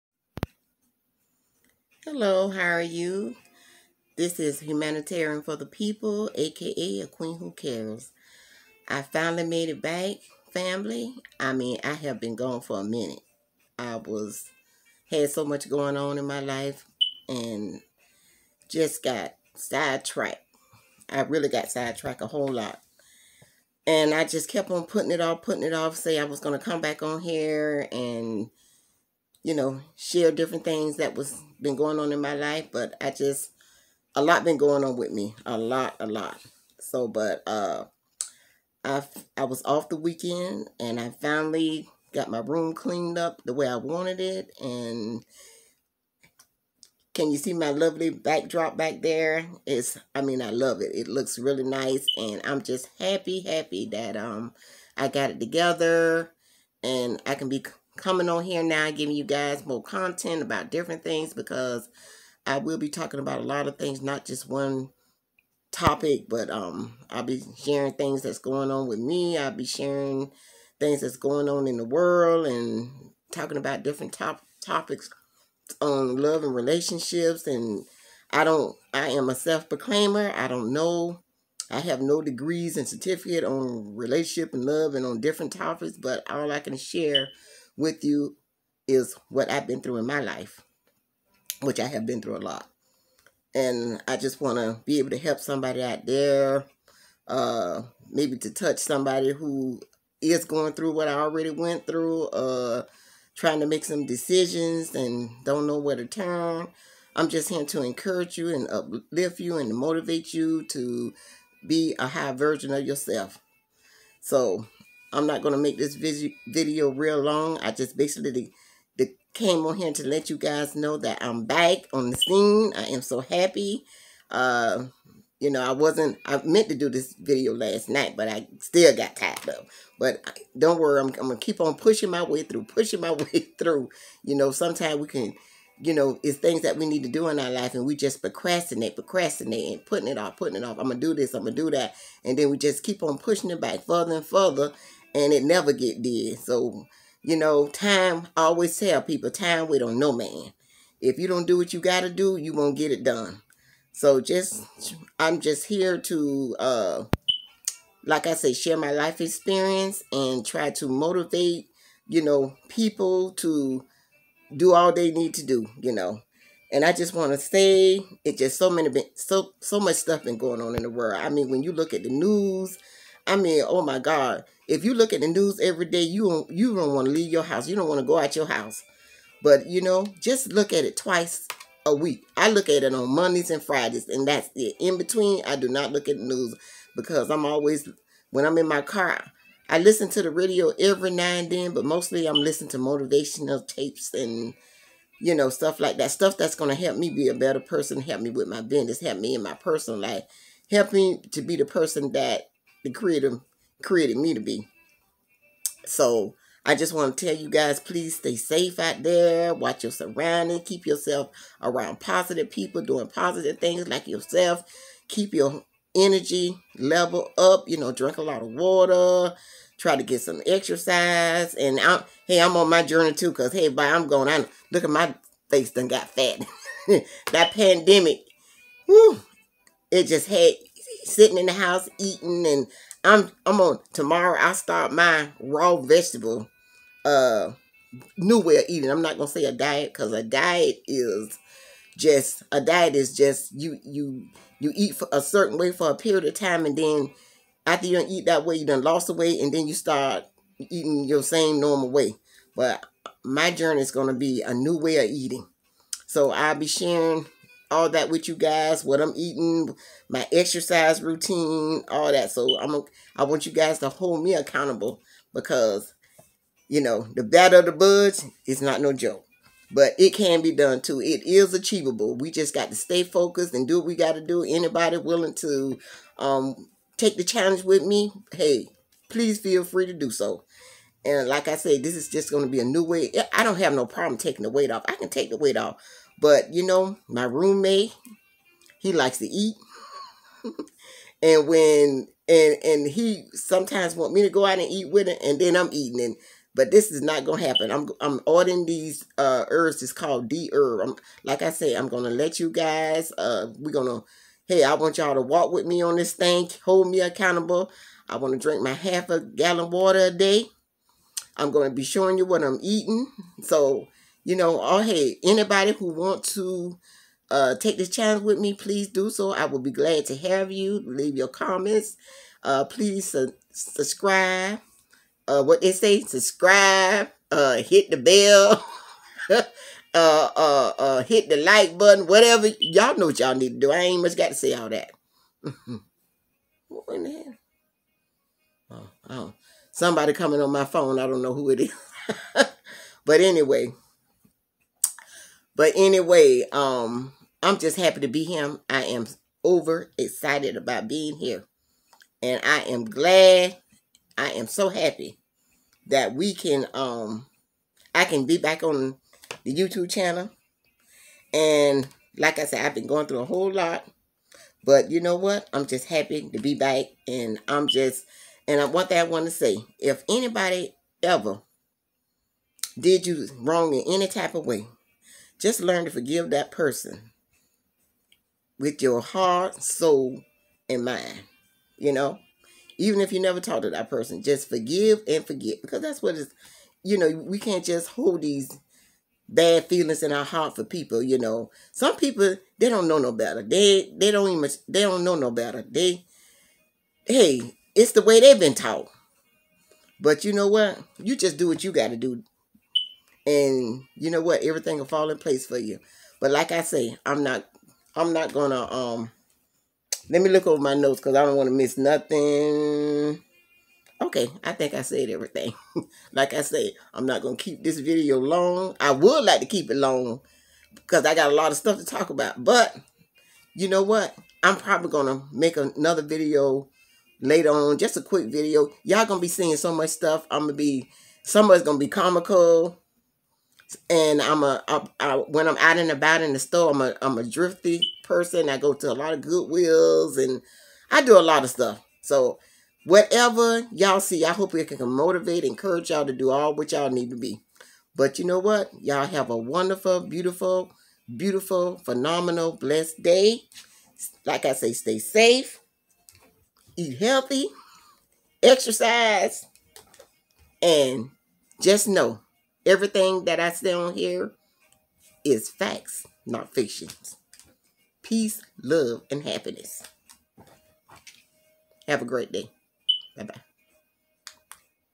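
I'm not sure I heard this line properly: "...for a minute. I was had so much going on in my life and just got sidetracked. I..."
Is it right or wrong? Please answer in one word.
right.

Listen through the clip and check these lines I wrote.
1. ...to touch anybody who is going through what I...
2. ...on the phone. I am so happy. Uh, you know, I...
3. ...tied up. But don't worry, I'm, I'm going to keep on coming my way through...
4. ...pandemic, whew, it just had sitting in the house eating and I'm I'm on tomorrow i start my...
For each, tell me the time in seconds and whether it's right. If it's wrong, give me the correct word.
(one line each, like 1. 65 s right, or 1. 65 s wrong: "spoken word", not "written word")
1. 98 s wrong: "somebody", not "anybody"
2. 121 s wrong: "scene", not "phone"
3. 129 s wrong: "pushing", not "coming"
4. 227 s right.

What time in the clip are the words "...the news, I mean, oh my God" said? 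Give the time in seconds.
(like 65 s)
172 s.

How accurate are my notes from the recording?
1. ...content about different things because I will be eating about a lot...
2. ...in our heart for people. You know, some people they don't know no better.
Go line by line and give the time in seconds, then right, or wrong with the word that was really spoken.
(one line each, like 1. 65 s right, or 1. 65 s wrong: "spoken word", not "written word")
1. 59 s wrong: "talking", not "eating"
2. 390 s right.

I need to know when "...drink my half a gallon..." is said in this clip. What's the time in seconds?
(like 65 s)
308 s.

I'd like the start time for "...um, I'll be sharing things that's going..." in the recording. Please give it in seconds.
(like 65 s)
66 s.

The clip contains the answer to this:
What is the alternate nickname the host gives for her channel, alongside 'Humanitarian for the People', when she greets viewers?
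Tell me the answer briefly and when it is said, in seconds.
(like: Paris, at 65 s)
A Queen Who Cares, at 7 s.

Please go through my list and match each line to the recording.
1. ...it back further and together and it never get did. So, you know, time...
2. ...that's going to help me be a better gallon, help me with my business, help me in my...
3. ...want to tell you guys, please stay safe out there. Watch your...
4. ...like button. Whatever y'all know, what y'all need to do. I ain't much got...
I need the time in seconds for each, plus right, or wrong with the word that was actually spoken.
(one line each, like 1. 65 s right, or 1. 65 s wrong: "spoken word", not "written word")
1. 143 s wrong: "further", not "together"
2. 196 s wrong: "person", not "gallon"
3. 206 s right
4. 331 s right.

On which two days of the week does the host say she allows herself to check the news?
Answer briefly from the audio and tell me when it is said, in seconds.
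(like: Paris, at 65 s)
Mondays and Fridays, at 183 s.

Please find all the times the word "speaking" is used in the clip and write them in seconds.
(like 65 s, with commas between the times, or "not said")
not said.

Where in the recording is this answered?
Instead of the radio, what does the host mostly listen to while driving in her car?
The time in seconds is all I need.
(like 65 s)
192 s.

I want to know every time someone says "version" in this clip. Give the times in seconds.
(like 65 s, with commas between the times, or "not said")
112 s.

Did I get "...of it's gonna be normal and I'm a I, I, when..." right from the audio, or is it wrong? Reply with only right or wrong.
wrong.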